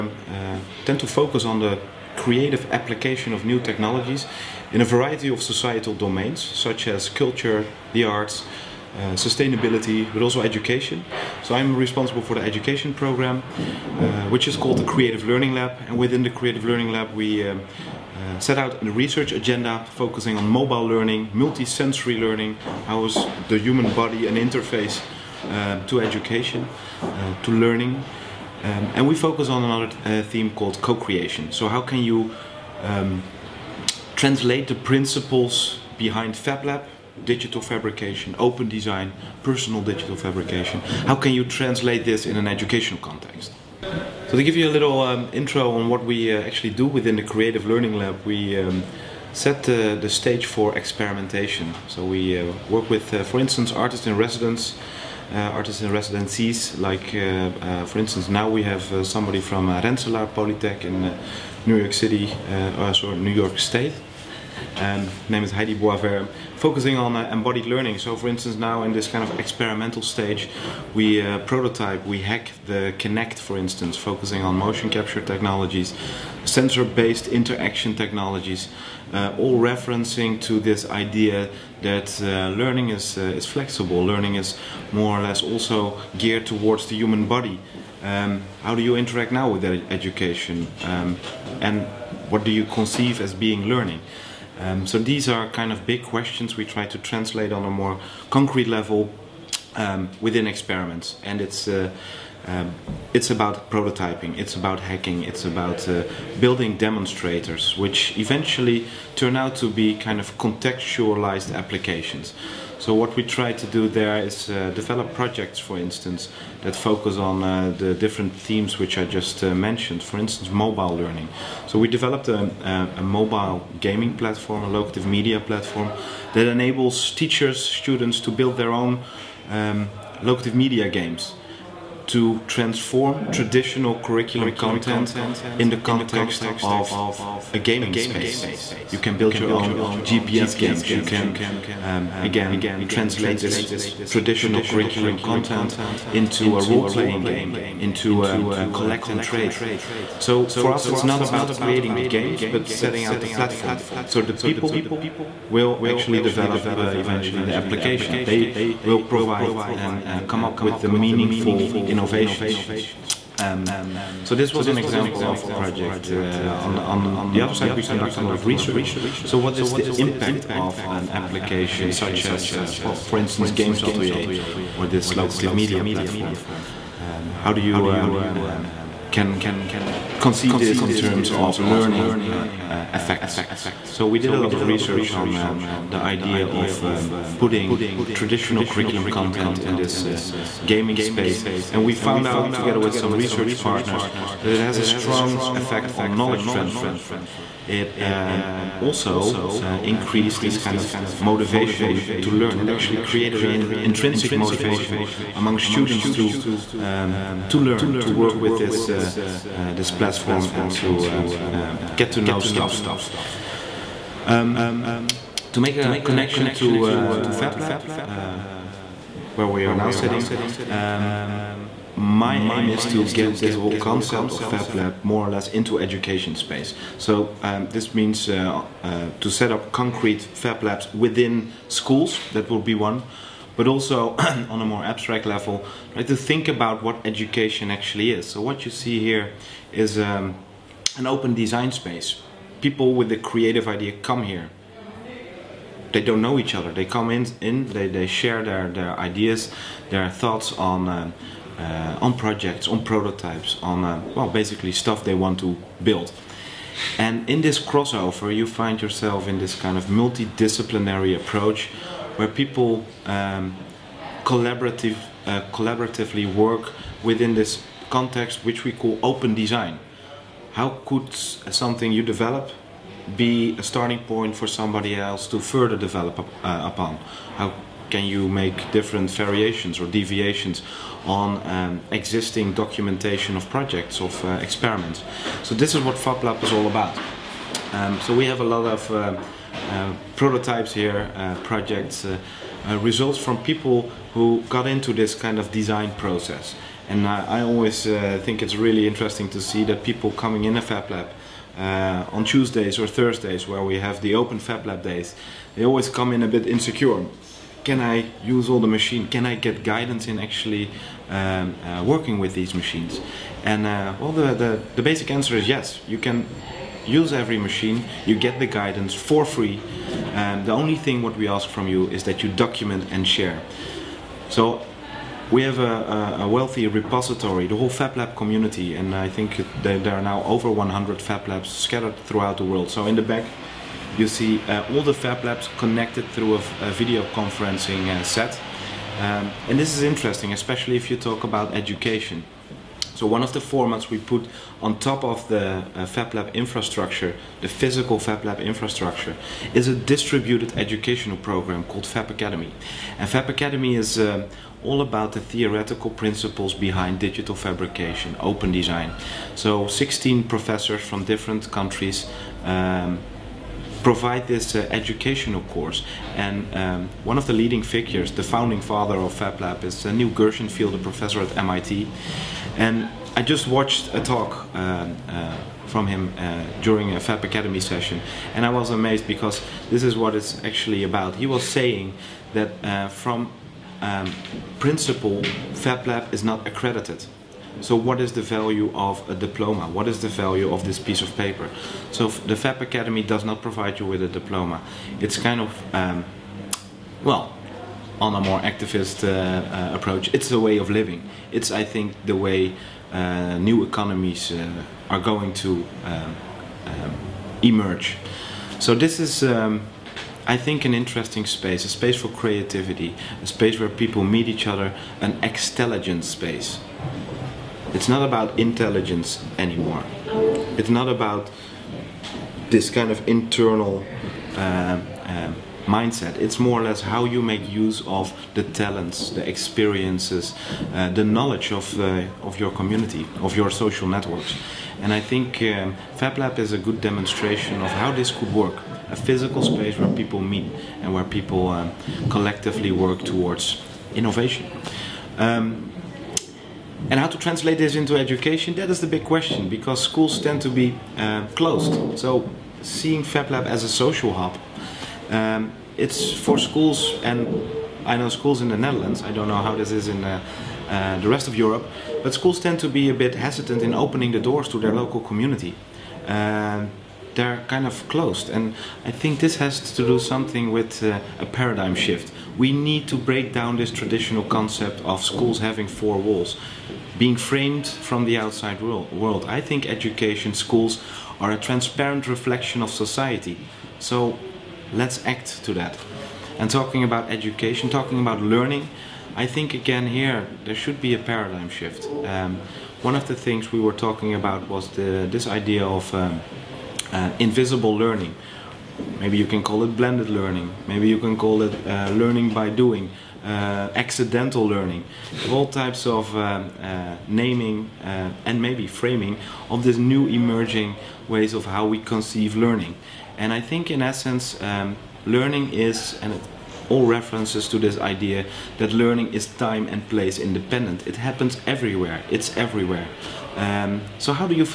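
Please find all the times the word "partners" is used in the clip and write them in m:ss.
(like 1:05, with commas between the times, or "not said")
3:13.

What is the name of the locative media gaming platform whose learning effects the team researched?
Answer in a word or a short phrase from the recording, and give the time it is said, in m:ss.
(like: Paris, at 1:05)
Games Atelier, at 2:53.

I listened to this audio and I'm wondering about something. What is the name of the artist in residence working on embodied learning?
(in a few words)
Heidi Boisvert.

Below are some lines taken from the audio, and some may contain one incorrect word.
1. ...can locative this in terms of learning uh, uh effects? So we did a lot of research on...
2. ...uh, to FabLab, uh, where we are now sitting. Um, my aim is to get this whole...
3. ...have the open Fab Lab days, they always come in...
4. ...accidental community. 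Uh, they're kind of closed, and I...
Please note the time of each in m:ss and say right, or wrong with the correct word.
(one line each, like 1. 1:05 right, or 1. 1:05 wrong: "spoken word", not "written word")
1. 2:59 wrong: "conceive", not "locative"
2. 3:36 right
3. 5:03 right
4. 7:44 wrong: "local", not "accidental".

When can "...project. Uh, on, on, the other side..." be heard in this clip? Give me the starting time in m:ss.
2:45.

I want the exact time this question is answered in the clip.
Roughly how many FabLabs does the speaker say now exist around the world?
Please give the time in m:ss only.
5:30.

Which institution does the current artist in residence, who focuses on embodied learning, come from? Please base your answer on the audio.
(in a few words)
Rensselaer Polytech.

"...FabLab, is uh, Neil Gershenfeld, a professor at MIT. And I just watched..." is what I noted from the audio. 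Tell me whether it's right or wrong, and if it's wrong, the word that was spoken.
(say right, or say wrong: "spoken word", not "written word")
right.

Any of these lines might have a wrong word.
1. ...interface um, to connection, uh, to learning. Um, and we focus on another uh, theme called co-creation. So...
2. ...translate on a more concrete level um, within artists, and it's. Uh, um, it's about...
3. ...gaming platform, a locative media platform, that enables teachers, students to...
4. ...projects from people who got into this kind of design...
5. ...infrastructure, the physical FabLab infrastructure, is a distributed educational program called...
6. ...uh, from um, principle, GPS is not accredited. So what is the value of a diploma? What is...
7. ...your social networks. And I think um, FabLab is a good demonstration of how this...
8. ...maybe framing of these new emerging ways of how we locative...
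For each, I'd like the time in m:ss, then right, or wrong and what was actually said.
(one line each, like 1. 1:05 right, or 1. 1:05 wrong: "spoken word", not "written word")
1. 0:24 wrong: "education", not "connection"
2. 1:36 wrong: "experiments", not "artists"
3. 2:03 right
4. 4:52 wrong: "results", not "projects"
5. 5:46 right
6. 6:22 wrong: "FabLab", not "GPS"
7. 7:13 right
8. 8:28 wrong: "conceive", not "locative".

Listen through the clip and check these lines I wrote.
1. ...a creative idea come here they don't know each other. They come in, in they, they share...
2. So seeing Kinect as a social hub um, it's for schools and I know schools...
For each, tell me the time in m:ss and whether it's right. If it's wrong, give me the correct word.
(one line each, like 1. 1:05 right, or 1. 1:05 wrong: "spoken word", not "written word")
1. 4:03 right
2. 7:31 wrong: "FabLab", not "Kinect".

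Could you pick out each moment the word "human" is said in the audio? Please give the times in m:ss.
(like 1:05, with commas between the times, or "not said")
0:23, 1:26.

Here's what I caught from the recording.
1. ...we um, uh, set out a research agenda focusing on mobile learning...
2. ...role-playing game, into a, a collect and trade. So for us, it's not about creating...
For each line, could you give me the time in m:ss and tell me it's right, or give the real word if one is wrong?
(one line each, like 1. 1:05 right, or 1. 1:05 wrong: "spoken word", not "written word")
1. 0:17 right
2. 2:26 right.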